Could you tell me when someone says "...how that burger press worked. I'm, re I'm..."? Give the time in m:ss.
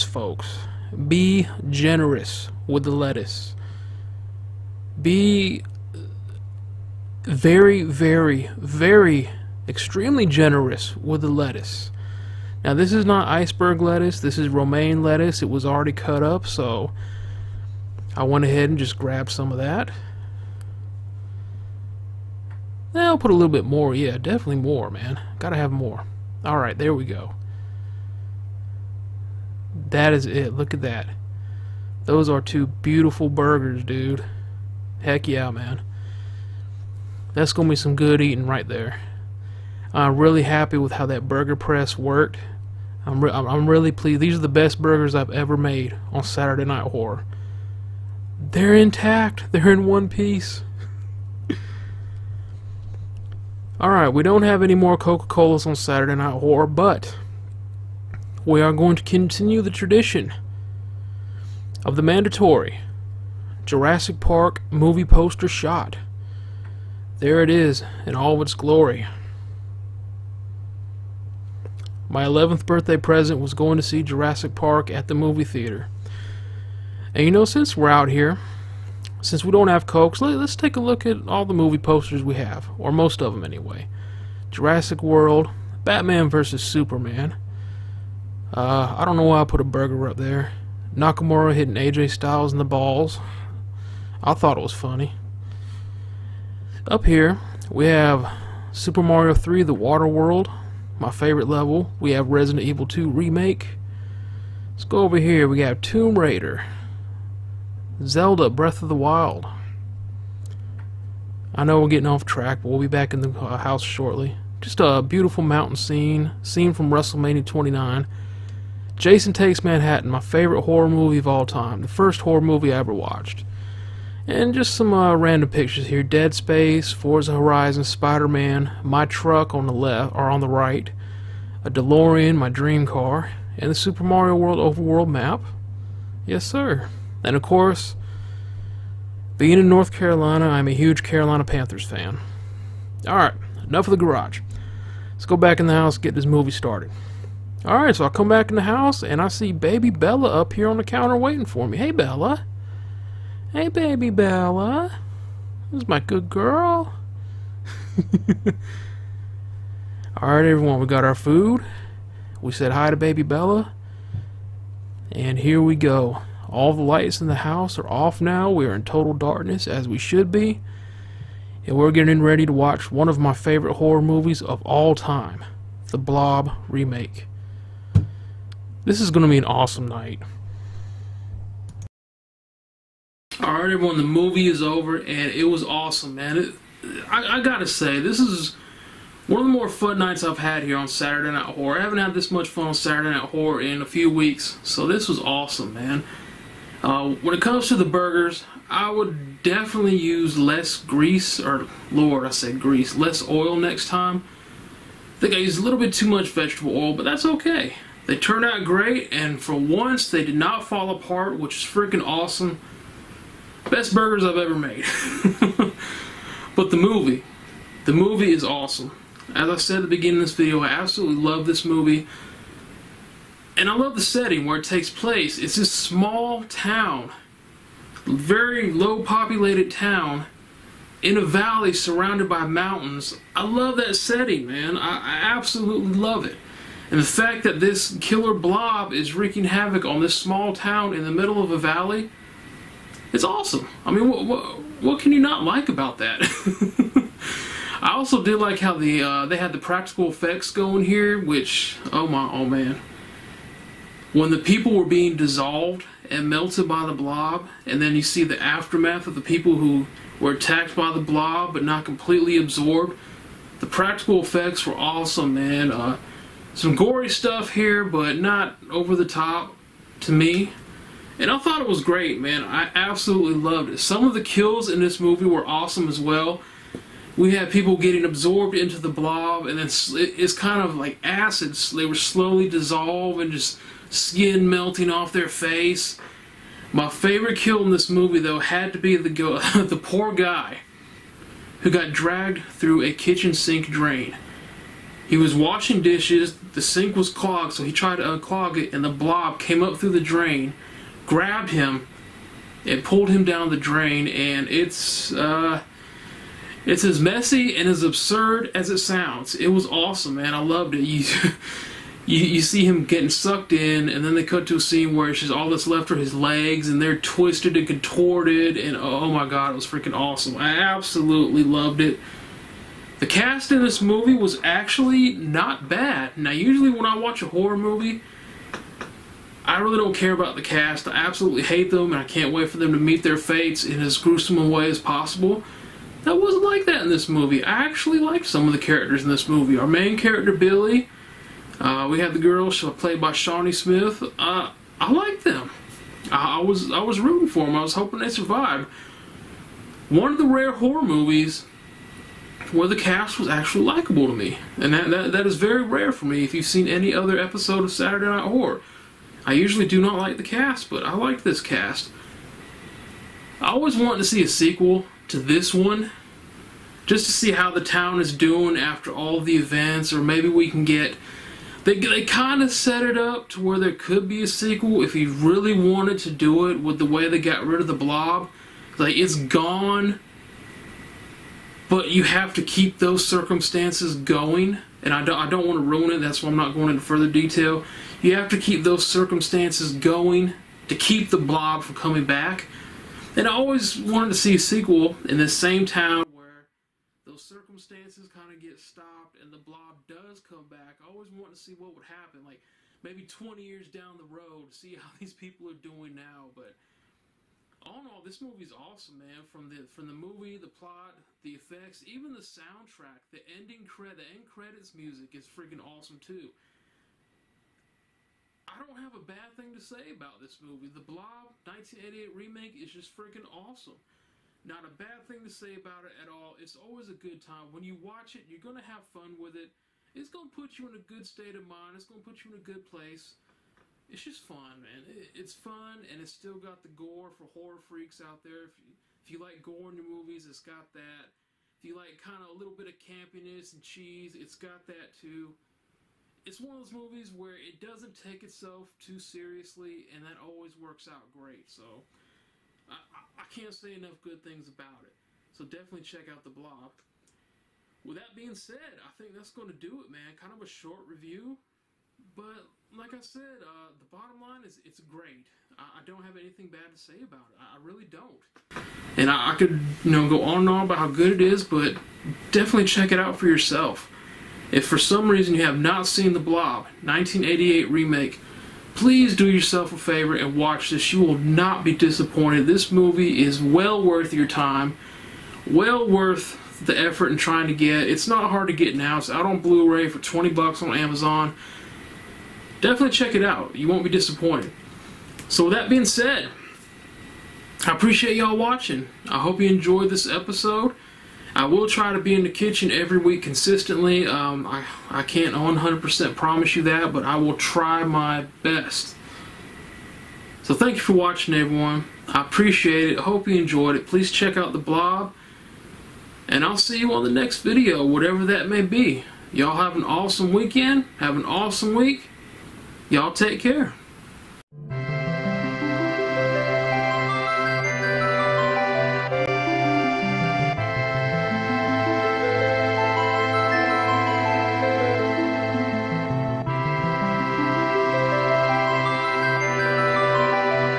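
0:40.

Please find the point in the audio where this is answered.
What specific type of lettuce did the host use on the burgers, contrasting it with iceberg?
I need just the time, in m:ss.
0:14.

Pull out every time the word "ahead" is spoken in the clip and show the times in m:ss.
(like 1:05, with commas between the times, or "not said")
0:18.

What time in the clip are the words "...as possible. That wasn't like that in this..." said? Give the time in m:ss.
5:34.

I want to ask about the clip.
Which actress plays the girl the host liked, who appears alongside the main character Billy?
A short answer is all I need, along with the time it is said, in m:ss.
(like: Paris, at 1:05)
Shawnee Smith, at 5:43.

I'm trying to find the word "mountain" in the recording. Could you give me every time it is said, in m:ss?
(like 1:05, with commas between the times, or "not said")
1:55, 3:52.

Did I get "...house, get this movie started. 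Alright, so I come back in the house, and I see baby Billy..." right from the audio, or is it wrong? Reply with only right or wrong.
wrong.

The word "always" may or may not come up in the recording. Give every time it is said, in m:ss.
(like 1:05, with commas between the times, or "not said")
6:03, 6:33, 6:40, 7:06, 7:30.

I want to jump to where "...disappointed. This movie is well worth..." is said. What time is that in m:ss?
8:01.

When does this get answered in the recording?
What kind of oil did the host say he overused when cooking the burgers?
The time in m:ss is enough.
3:26.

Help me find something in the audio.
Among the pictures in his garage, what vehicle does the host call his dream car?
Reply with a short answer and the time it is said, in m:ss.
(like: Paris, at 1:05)
DeLorean, at 2:11.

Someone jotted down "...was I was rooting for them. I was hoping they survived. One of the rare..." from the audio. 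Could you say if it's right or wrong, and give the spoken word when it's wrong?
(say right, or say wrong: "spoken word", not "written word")
right.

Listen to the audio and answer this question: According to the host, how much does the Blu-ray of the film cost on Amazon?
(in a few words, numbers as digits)
20 bucks.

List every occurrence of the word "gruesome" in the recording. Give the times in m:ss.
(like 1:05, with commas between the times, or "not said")
5:33.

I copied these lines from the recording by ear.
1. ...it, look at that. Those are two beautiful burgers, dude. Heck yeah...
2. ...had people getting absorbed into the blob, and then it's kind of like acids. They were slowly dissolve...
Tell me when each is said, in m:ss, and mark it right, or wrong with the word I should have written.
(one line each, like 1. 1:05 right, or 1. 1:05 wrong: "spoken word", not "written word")
1. 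0:30 right
2. 4:37 right.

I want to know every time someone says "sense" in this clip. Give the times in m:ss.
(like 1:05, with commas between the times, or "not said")
not said.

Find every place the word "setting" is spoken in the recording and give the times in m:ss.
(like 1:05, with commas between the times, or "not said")
3:44, 3:53.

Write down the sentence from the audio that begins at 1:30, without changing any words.
Nakamura hitting AJ Styles in the balls.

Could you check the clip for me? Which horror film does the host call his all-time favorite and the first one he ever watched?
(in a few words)
Jason Takes Manhattan.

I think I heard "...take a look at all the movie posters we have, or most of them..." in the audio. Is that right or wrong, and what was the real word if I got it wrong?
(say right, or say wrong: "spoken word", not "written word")
right.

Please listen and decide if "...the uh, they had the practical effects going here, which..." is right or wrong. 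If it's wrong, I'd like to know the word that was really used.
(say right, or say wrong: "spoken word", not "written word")
right.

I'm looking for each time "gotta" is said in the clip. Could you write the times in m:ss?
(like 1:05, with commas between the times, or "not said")
0:25, 3:07.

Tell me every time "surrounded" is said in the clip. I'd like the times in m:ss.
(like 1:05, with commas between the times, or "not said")
3:51.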